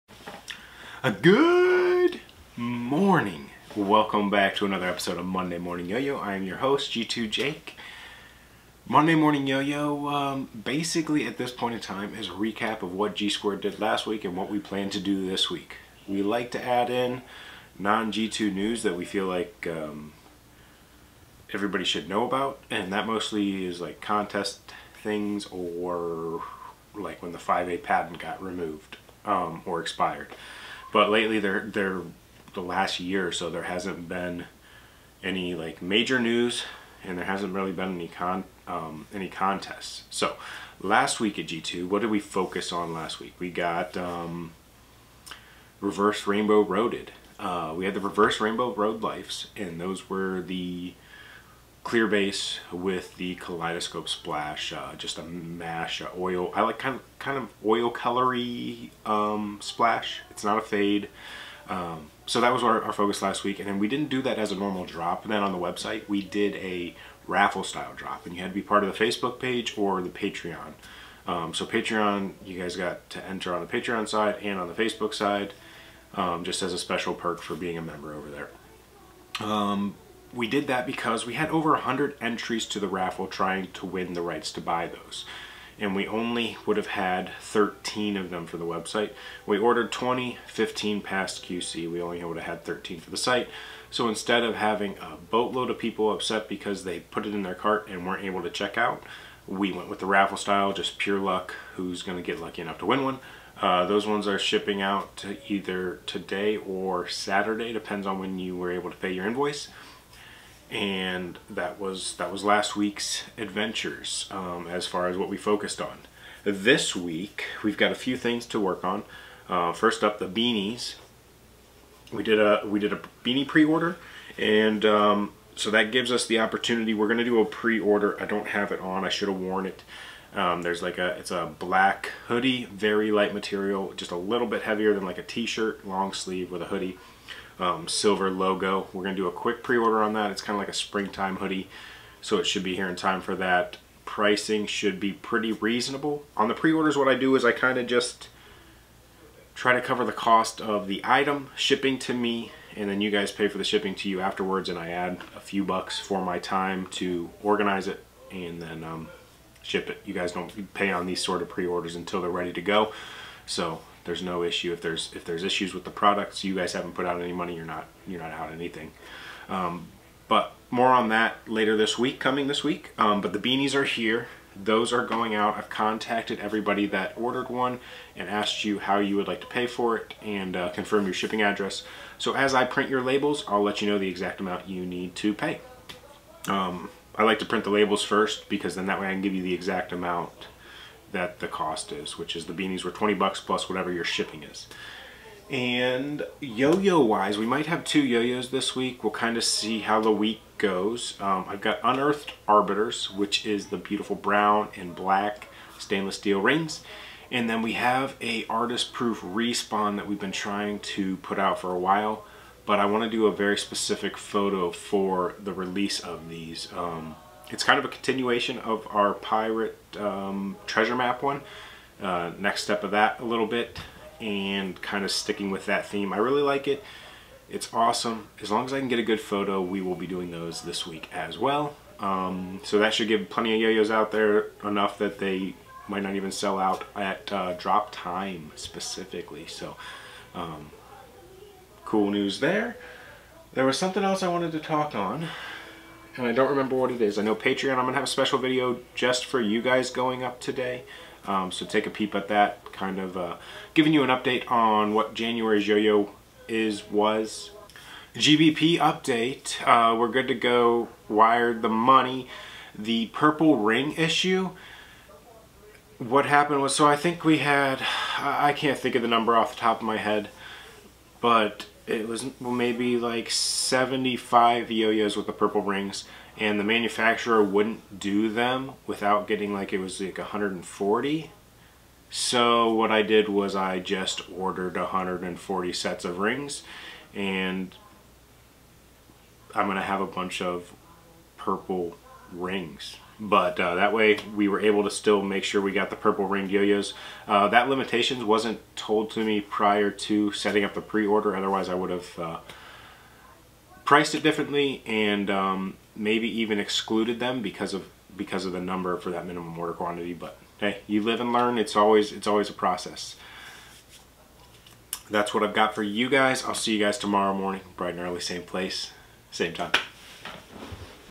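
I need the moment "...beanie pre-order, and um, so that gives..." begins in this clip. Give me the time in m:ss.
2:03.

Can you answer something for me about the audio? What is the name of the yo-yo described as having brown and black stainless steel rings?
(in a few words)
Unearthed Arbiters.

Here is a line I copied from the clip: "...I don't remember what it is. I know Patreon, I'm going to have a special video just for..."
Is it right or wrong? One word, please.
right.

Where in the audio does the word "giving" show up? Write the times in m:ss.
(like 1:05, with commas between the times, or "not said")
4:13.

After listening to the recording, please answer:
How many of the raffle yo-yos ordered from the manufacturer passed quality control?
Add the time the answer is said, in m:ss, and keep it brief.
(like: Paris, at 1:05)
15, at 1:30.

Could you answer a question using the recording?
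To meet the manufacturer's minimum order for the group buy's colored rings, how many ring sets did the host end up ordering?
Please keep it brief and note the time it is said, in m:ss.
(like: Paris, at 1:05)
140, at 4:44.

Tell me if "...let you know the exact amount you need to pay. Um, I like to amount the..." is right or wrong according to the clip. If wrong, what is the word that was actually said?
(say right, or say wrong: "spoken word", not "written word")
wrong: "print", not "amount".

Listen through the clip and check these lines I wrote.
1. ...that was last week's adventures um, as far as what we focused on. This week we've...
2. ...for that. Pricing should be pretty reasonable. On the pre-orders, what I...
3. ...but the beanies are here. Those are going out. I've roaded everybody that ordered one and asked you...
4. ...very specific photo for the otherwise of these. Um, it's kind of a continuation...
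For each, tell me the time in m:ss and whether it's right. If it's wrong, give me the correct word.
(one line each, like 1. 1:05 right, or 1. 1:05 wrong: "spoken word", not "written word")
1. 1:52 right
2. 2:23 right
3. 2:53 wrong: "contacted", not "roaded"
4. 3:33 wrong: "release", not "otherwise".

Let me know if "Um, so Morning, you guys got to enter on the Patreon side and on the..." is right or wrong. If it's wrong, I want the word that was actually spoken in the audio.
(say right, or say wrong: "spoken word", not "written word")
wrong: "Patreon", not "Morning".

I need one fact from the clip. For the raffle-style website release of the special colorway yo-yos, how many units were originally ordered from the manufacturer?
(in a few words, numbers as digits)
20.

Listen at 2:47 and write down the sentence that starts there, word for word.
You're not you're not out anything.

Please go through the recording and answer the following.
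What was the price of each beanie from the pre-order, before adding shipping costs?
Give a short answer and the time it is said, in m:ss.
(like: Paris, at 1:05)
$20, at 3:12.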